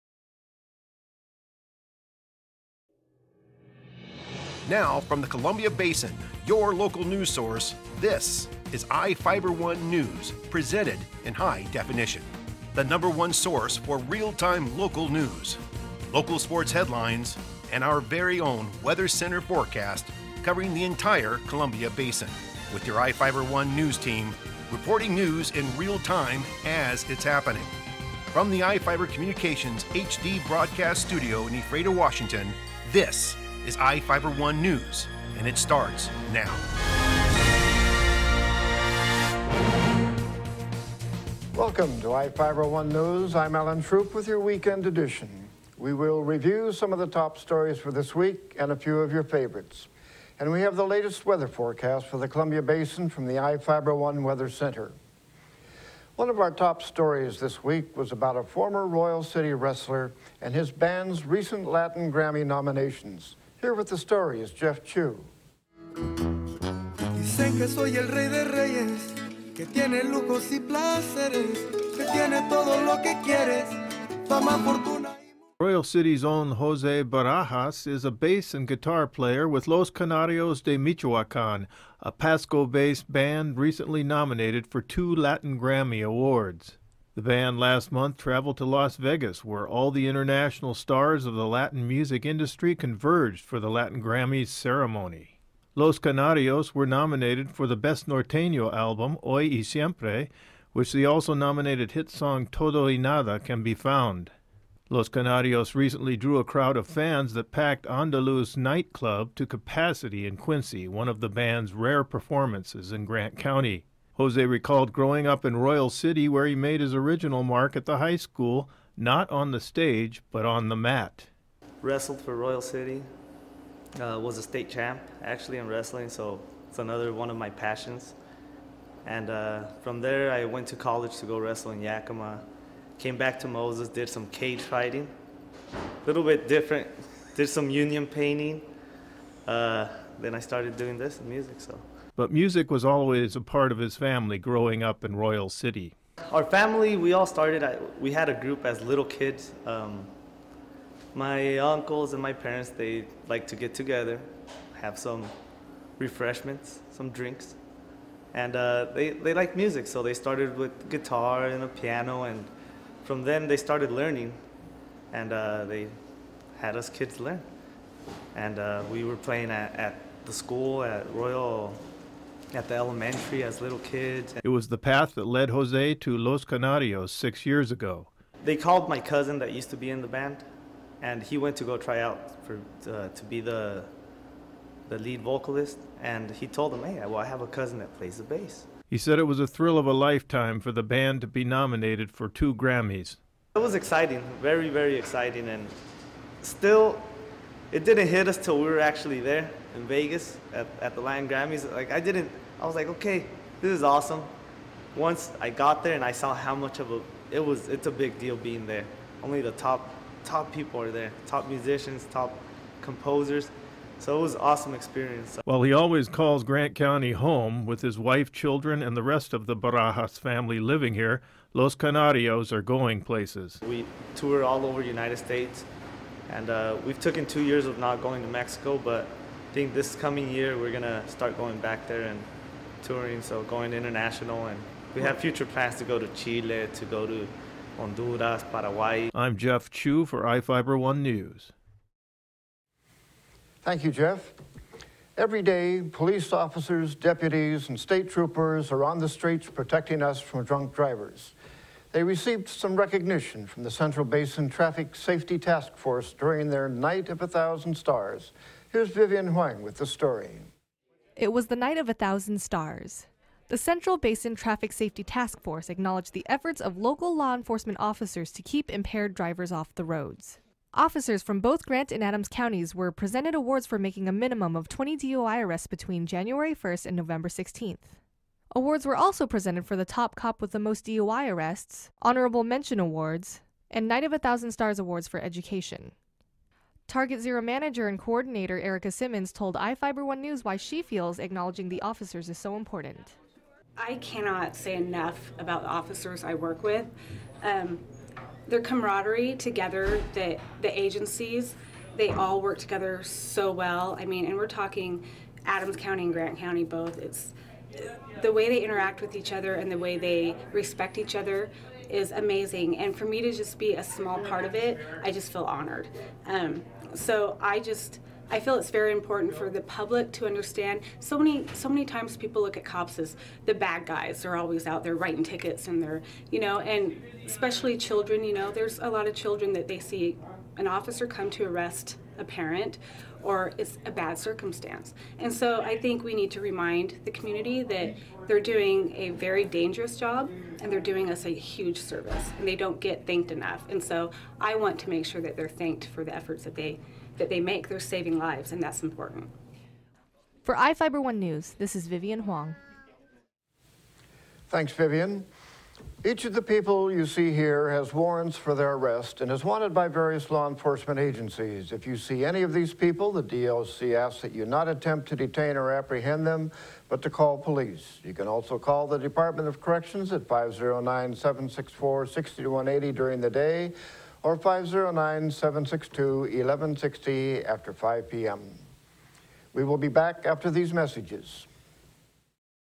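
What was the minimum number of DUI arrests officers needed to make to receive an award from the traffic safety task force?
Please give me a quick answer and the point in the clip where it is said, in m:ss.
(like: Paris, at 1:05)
20, at 4:34.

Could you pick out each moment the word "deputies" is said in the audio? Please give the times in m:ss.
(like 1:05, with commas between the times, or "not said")
4:06.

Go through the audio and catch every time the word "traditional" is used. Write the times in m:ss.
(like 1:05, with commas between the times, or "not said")
not said.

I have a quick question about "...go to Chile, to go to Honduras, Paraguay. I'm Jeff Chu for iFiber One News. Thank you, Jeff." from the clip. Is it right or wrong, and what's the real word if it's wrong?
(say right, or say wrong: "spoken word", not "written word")
right.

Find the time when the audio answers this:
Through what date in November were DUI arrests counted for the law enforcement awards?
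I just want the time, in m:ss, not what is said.
4:36.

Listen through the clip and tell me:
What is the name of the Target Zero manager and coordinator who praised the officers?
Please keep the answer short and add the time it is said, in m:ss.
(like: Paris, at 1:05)
Erica Simmons, at 4:48.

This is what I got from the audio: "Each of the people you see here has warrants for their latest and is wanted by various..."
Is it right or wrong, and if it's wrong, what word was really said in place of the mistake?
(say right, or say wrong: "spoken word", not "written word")
wrong: "arrest", not "latest".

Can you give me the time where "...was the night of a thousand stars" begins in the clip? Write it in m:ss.
4:21.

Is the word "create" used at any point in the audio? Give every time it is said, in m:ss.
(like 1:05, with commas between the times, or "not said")
not said.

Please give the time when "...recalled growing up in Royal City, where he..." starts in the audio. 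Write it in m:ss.
1:54.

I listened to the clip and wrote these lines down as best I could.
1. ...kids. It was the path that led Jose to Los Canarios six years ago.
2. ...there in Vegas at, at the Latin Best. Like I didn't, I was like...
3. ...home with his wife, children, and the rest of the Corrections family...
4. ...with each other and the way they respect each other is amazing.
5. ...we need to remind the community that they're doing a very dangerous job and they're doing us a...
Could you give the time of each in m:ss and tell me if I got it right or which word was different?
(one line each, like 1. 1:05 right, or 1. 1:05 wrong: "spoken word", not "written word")
1. 2:53 right
2. 3:19 wrong: "Grammys", not "Best"
3. 3:37 wrong: "Barajas", not "Corrections"
4. 5:08 right
5. 5:36 right.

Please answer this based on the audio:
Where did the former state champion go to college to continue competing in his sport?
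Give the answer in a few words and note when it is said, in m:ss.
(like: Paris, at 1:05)
Yakima, at 2:11.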